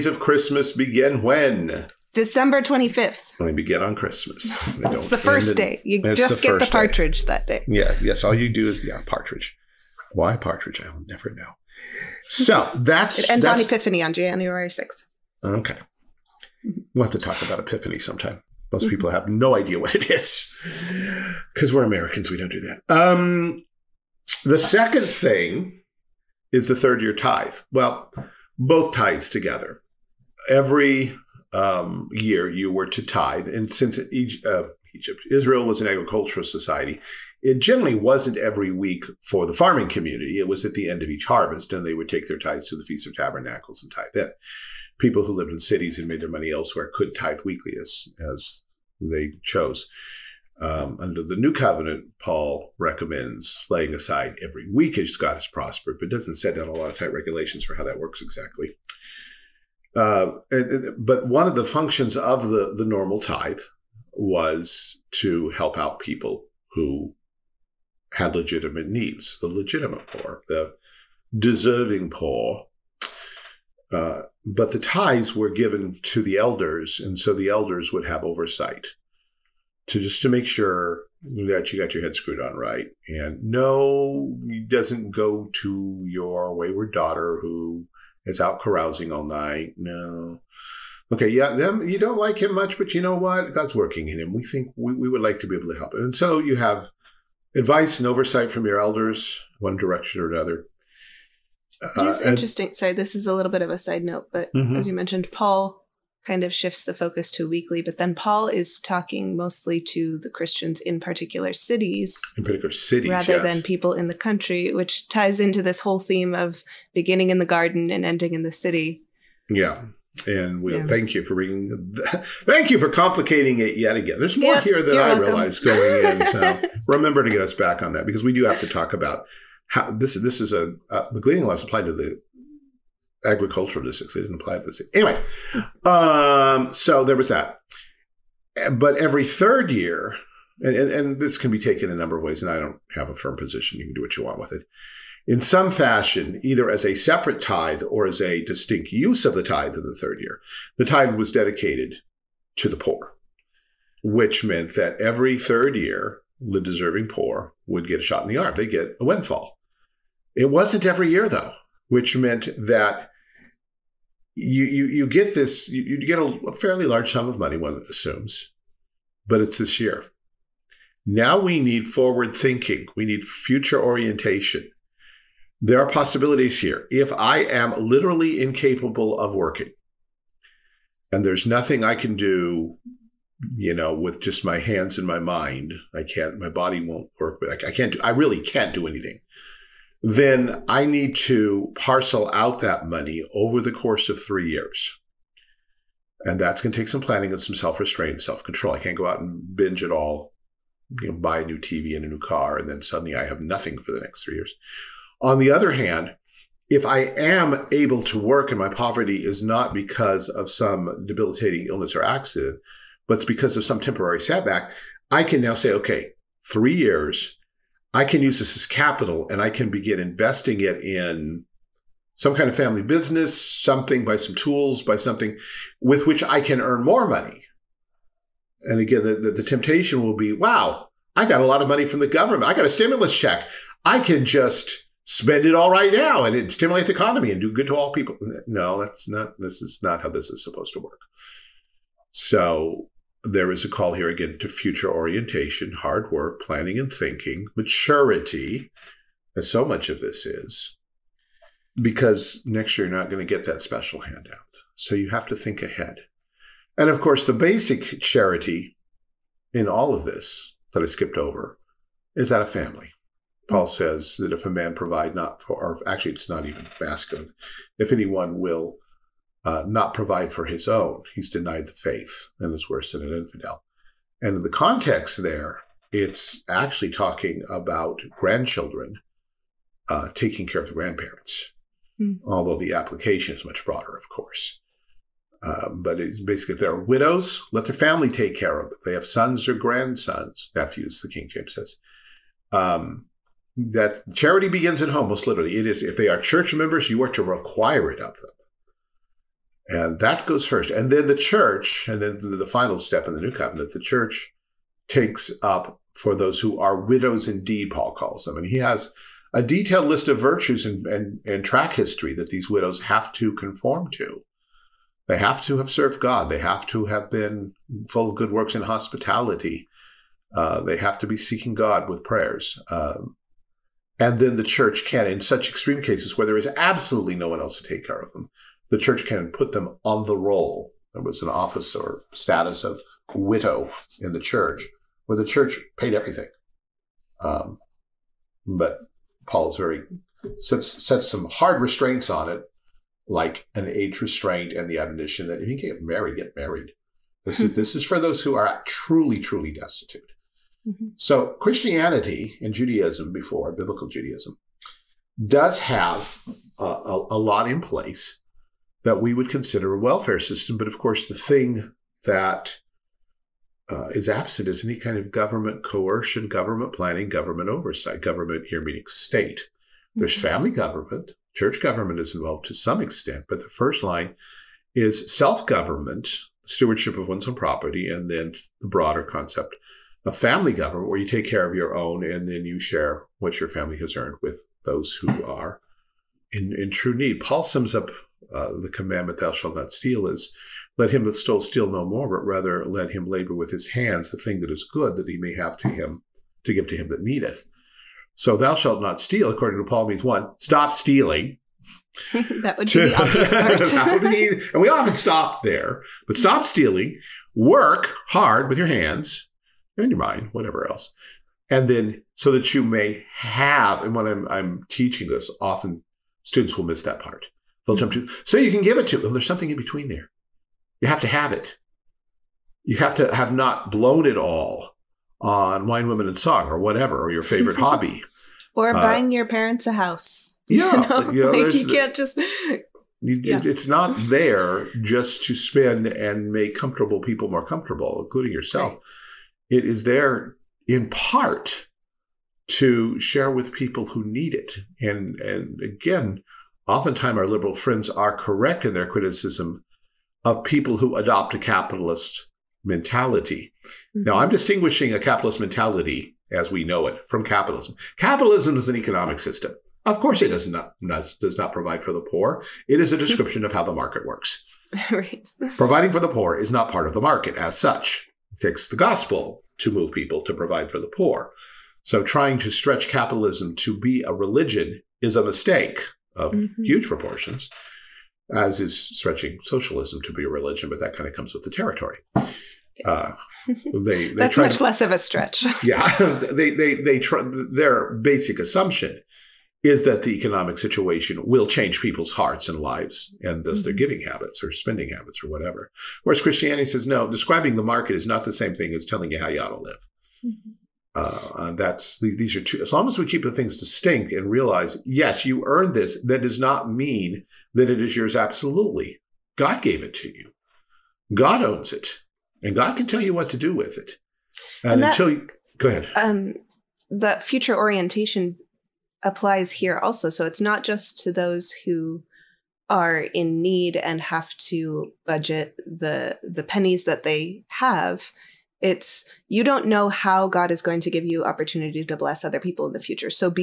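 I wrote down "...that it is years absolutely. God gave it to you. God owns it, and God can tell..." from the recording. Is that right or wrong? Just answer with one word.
wrong.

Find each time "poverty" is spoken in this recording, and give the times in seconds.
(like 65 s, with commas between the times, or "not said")
208 s.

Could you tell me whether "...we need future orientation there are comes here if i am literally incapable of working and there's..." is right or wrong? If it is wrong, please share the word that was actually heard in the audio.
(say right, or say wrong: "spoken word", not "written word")
wrong: "possibilities", not "comes".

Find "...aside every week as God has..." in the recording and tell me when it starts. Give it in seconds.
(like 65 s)
53 s.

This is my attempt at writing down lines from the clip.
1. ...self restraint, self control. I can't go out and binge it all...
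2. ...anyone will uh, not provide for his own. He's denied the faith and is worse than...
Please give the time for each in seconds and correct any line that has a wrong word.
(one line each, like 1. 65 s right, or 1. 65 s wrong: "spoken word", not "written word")
1. 197 s right
2. 267 s right.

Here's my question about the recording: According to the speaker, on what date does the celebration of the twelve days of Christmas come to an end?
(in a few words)
January 6th.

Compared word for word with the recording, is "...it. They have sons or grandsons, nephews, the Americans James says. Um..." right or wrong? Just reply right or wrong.
wrong.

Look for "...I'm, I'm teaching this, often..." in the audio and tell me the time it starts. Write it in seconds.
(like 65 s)
414 s.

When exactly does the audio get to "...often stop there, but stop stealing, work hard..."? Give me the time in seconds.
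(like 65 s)
404 s.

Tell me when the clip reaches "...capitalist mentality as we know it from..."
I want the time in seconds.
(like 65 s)
454 s.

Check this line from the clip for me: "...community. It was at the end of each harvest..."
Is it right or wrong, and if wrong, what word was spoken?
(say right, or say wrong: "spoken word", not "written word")
right.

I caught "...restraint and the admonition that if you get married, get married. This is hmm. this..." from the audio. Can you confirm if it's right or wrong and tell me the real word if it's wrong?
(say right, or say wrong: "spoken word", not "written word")
right.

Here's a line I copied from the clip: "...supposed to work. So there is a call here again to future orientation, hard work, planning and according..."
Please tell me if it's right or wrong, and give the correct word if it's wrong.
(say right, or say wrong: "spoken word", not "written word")
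wrong: "thinking", not "according".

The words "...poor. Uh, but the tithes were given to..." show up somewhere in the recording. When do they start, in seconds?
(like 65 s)
72 s.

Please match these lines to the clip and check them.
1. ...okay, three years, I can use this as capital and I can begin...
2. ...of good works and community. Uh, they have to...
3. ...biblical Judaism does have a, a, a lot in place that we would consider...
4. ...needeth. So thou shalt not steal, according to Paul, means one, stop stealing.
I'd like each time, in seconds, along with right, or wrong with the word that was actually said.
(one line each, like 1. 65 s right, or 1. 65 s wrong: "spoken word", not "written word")
1. 215 s right
2. 318 s wrong: "hospitality", not "community"
3. 353 s right
4. 397 s right.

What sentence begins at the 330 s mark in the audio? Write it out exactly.
There was an office or status of widow in the church where the church paid everything.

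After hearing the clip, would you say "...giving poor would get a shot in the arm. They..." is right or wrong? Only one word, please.
wrong.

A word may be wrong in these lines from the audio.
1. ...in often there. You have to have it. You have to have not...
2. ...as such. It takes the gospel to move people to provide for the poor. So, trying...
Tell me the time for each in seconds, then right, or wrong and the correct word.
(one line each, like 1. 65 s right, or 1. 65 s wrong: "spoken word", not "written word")
1. 419 s wrong: "between", not "often"
2. 467 s right.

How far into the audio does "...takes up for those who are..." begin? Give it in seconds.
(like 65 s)
304 s.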